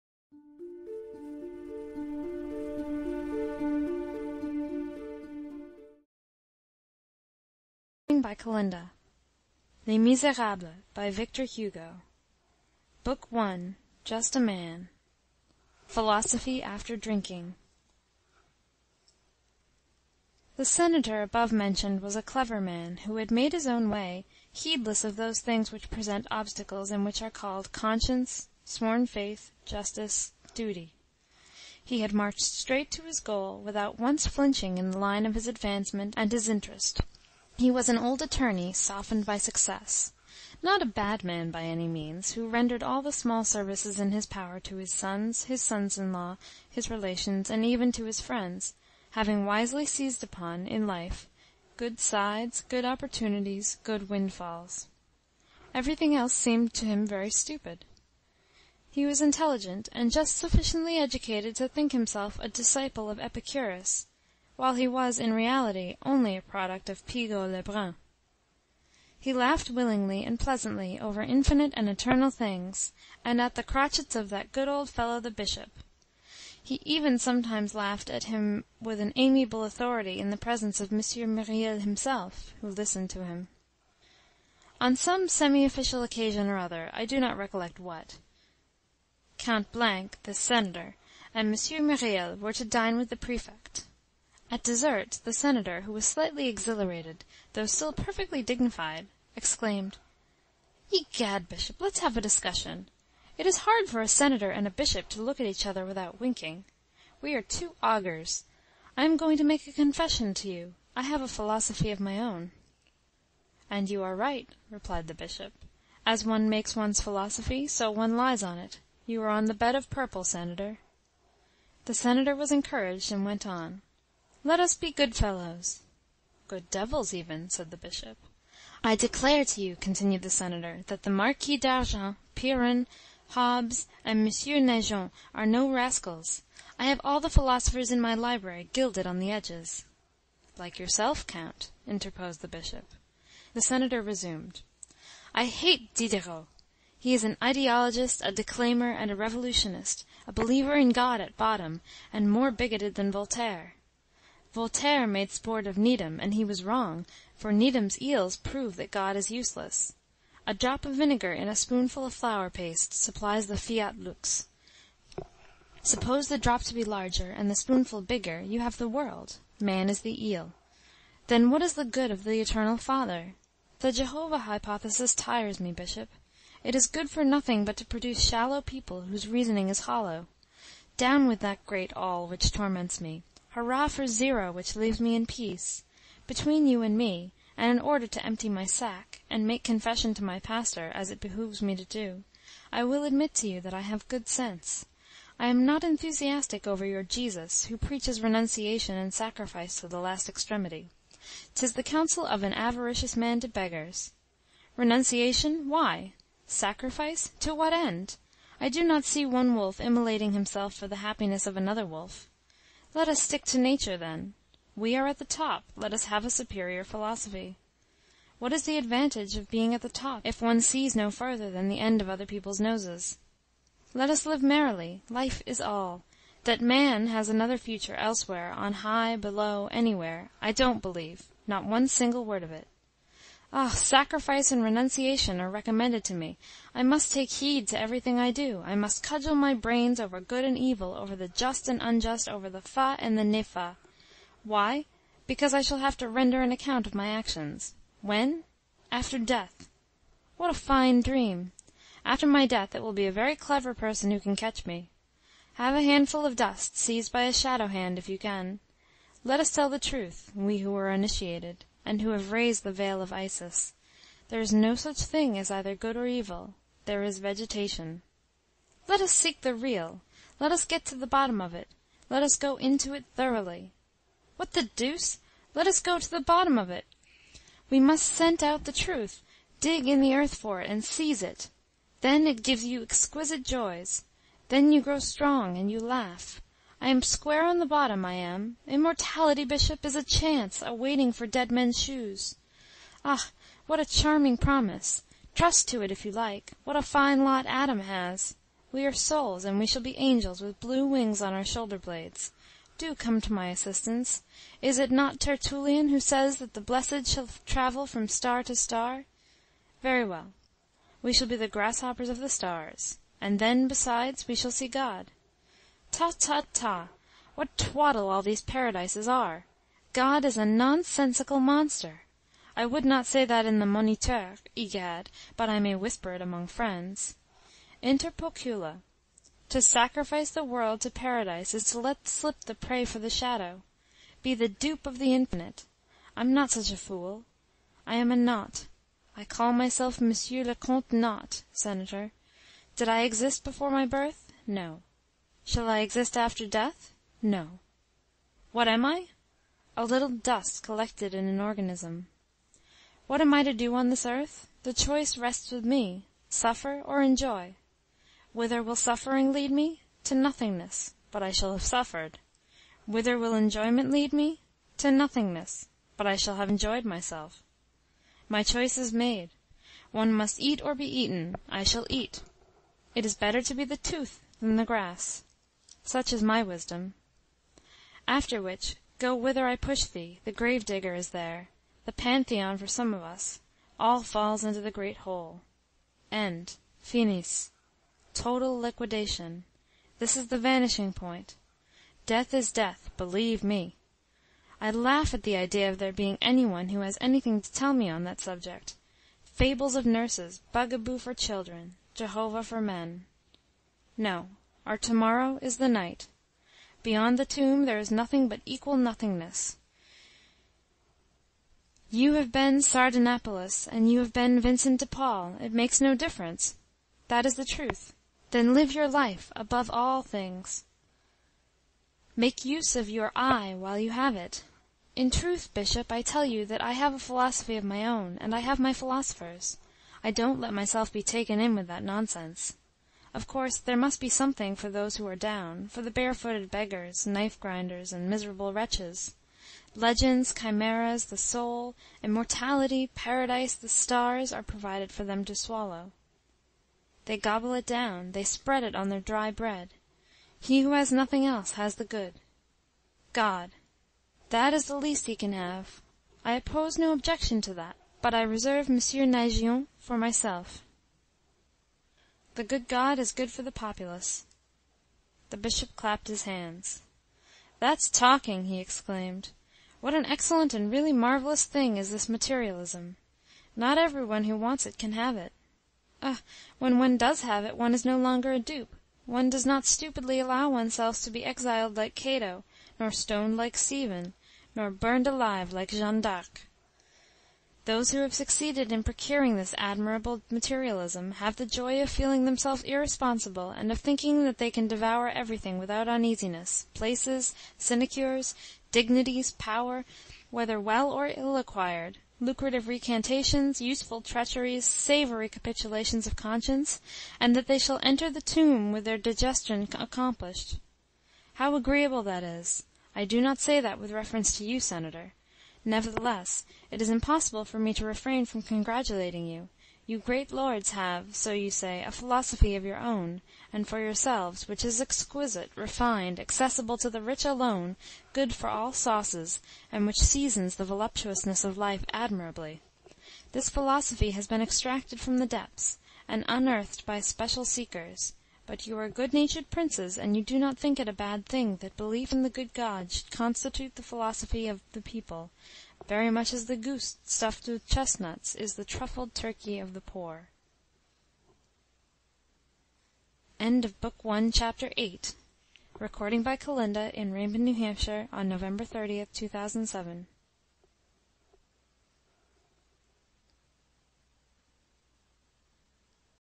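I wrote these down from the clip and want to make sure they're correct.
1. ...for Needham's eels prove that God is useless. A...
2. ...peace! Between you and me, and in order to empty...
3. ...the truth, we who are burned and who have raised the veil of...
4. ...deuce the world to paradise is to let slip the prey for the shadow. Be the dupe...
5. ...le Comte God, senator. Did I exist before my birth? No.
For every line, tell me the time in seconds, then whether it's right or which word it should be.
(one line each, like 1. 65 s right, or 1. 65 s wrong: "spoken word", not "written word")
1. 157 s right
2. 185 s right
3. 259 s wrong: "initiated", not "burned"
4. 329 s wrong: "sacrifice", not "deuce"
5. 340 s wrong: "Nought", not "God".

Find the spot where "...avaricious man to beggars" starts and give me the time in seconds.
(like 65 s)
202 s.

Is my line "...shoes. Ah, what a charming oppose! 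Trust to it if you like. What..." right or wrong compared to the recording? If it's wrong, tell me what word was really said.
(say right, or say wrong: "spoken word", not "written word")
wrong: "promise", not "oppose".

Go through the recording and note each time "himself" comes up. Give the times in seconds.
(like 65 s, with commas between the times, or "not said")
61 s, 81 s, 210 s.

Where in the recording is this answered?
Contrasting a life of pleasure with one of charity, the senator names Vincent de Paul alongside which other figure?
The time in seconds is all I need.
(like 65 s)
412 s.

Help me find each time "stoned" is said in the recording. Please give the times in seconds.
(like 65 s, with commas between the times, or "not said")
482 s.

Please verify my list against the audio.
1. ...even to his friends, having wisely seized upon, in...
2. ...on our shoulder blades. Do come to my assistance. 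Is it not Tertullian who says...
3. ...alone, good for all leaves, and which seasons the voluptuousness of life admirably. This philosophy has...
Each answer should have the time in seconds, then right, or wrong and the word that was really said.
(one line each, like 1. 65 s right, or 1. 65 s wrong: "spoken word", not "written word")
1. 47 s right
2. 301 s right
3. 527 s wrong: "sauces", not "leaves".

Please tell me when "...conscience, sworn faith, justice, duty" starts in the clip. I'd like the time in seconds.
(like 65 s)
27 s.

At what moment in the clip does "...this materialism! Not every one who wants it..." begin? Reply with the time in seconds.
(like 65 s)
471 s.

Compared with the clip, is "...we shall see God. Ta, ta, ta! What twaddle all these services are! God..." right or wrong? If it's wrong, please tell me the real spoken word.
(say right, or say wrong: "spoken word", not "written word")
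wrong: "paradises", not "services".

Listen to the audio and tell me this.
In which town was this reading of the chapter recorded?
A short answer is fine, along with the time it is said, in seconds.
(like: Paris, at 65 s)
Raymond, New Hampshire, at 557 s.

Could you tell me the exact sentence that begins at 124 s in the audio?
Let us be good fellows." "Good devils even," said the Bishop.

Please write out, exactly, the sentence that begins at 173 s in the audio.
The Jehovah hypothesis tires me, Bishop.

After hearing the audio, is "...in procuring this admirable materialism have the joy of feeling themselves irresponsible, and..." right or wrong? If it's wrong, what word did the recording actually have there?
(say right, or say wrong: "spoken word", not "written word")
right.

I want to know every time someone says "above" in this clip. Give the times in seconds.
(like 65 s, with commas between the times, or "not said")
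21 s, 419 s.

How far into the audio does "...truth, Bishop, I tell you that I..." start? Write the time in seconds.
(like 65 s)
425 s.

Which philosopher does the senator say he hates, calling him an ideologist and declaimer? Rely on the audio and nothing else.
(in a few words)
Diderot.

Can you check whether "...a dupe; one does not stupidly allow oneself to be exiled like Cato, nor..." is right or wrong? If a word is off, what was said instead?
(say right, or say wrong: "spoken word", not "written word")
right.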